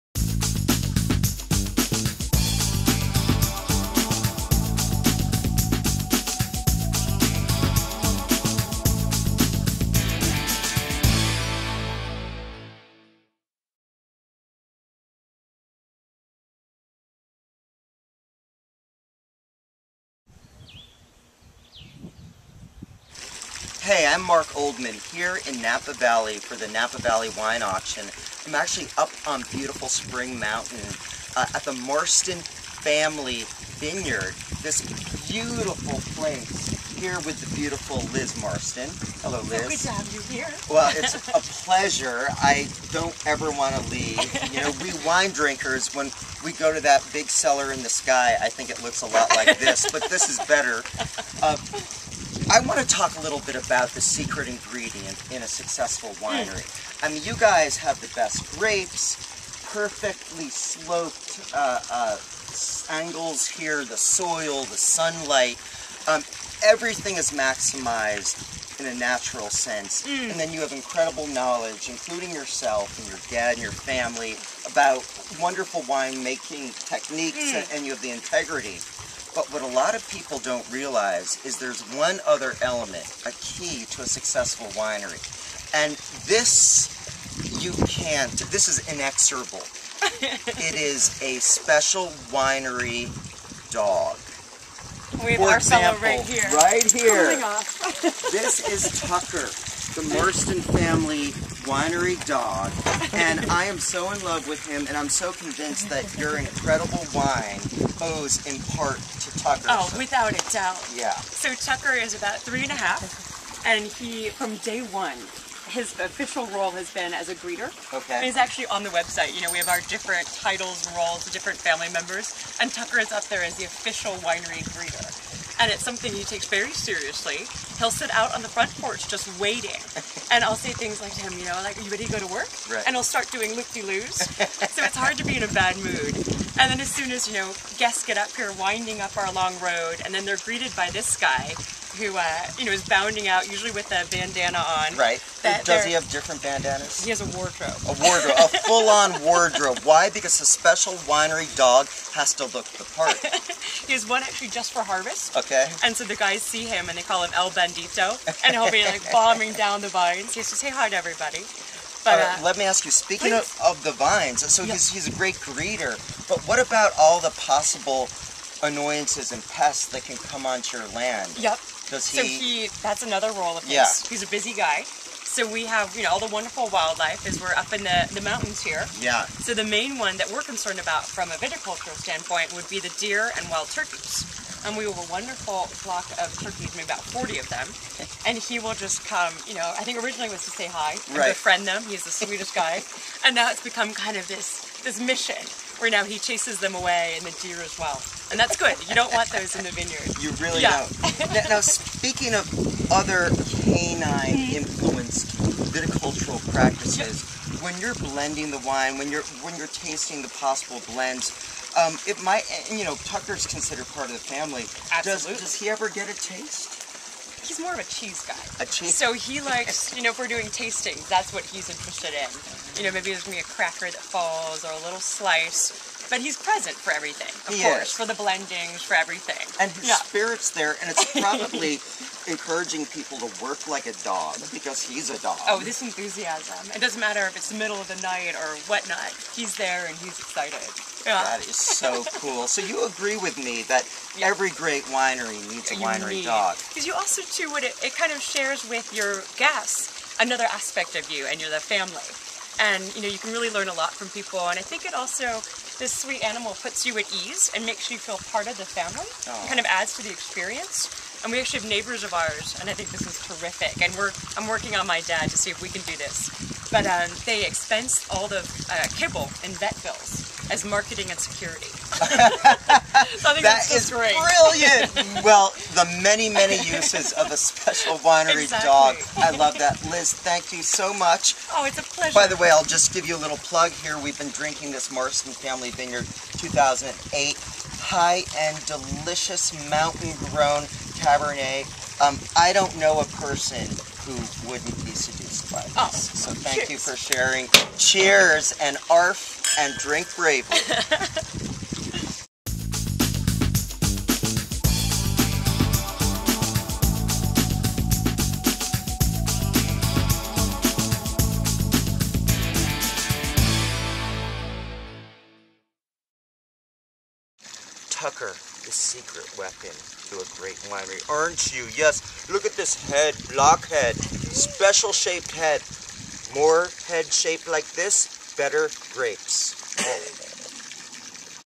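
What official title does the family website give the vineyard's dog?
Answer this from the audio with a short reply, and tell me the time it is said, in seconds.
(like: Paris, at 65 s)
official winery greeter, at 123 s.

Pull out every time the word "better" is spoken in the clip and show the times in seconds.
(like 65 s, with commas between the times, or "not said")
50 s, 328 s.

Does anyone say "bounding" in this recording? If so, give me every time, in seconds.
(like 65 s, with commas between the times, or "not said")
142 s.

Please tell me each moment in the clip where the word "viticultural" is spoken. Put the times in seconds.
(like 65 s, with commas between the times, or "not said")
181 s, 205 s.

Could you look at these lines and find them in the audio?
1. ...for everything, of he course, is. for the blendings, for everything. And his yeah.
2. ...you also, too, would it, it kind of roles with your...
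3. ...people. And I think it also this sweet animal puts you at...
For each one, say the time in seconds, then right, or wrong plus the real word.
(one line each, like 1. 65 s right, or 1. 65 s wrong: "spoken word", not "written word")
1. 226 s right
2. 246 s wrong: "shares", not "roles"
3. 254 s right.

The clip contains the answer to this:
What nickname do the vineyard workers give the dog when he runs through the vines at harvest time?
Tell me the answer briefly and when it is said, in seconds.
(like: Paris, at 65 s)
El Bendito, at 157 s.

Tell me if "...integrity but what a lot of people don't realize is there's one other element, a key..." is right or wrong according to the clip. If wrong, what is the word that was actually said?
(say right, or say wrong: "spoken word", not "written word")
right.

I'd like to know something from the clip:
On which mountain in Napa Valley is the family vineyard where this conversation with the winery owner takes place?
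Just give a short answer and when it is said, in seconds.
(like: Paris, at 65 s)
Spring Mountain, at 29 s.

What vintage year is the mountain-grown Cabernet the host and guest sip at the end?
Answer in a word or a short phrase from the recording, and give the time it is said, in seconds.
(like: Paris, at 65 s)
2008, at 286 s.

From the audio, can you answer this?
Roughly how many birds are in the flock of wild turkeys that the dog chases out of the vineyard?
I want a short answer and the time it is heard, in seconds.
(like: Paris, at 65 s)
40, at 187 s.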